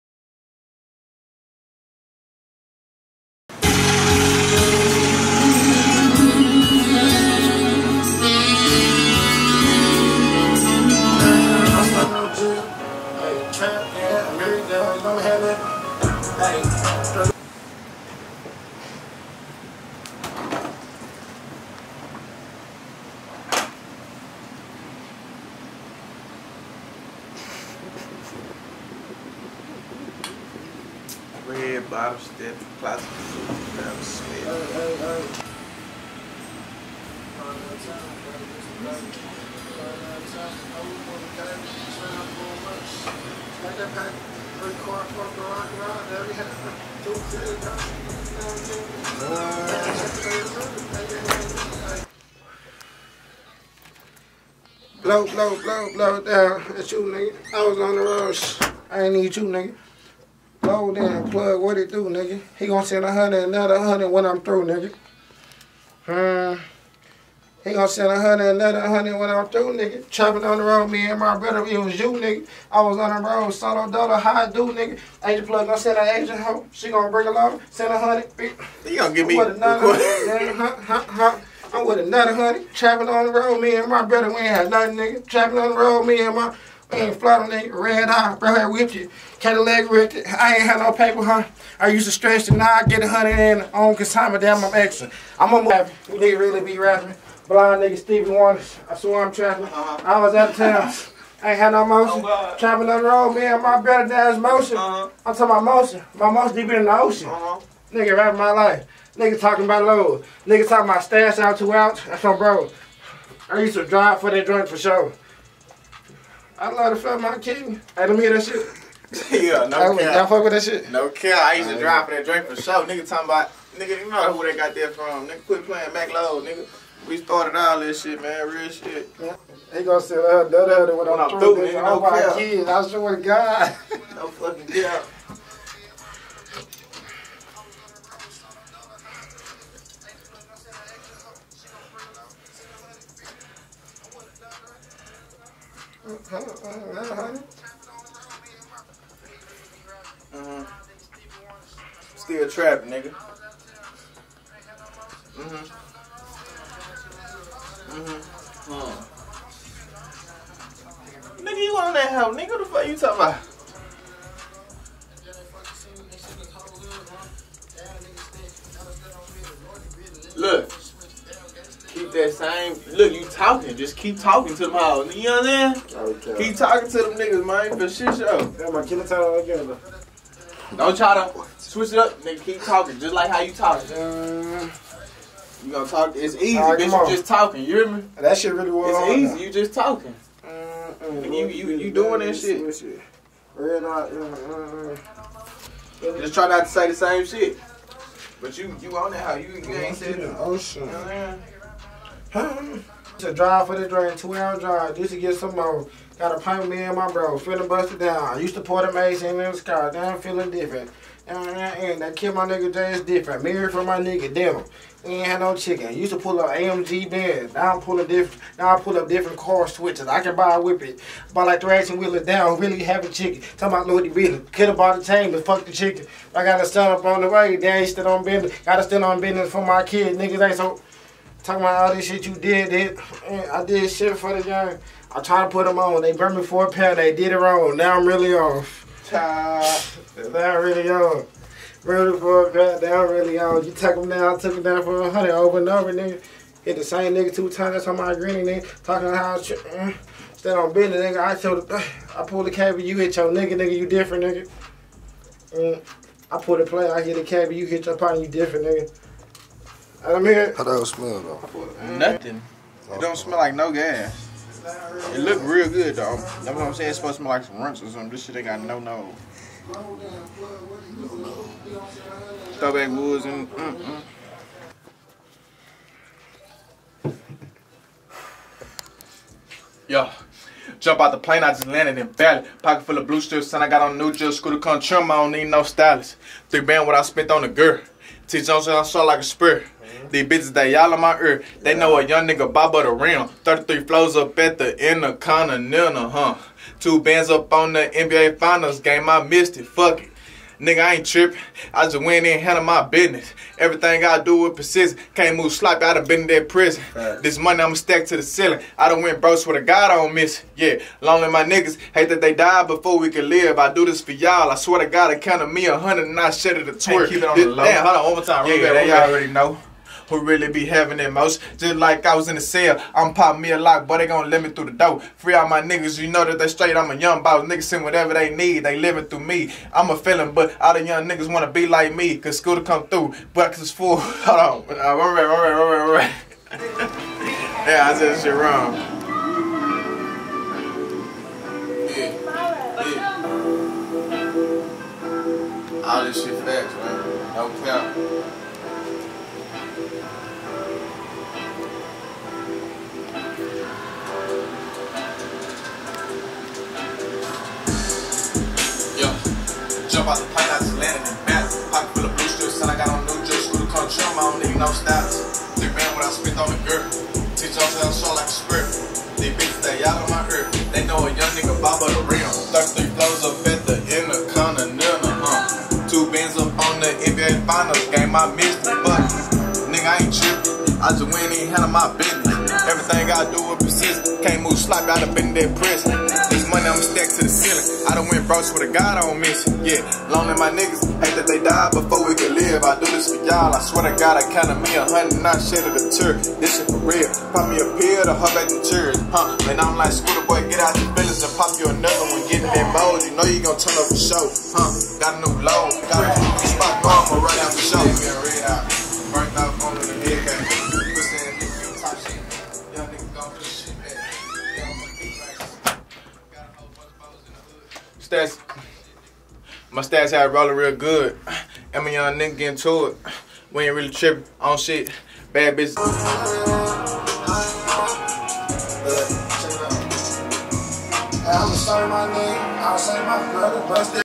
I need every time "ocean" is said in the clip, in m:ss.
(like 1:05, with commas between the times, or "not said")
1:47, 3:20.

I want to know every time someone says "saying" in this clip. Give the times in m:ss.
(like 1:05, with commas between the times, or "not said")
2:55, 4:26.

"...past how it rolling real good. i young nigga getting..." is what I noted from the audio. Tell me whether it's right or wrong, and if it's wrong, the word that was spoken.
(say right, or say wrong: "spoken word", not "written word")
right.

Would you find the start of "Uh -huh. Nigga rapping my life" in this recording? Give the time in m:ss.
1:47.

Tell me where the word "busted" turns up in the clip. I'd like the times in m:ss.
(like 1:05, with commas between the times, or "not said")
3:27.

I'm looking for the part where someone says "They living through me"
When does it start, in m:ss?
5:28.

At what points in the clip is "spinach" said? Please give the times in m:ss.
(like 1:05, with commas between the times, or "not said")
not said.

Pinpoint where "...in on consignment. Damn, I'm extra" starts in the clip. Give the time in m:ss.
1:33.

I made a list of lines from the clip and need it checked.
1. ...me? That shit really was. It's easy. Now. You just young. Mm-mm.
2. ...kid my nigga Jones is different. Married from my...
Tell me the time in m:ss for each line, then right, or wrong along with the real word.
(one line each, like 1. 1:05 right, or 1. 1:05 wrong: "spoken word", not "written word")
1. 3:07 wrong: "talking", not "young"
2. 3:32 wrong: "Jay", not "Jones".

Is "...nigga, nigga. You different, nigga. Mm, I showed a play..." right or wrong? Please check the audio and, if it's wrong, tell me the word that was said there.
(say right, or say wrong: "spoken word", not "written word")
wrong: "pulled", not "showed".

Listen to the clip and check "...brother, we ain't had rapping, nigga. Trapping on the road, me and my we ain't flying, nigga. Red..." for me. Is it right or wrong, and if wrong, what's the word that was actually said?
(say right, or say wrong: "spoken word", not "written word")
wrong: "nothing", not "rapping".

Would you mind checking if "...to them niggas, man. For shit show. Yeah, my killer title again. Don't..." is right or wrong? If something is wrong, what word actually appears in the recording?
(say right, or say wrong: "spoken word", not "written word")
right.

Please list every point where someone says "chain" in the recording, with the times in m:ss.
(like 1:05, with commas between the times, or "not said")
3:45.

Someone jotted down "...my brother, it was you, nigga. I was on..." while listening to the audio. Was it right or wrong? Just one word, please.
right.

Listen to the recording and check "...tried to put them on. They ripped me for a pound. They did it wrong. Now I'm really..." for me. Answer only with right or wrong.
wrong.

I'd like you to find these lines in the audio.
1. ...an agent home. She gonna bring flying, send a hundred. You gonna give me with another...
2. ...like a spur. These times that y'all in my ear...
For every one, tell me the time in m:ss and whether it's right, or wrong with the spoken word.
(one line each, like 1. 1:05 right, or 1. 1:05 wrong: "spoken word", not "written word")
1. 1:15 wrong: "along", not "flying"
2. 4:49 wrong: "bitches", not "times".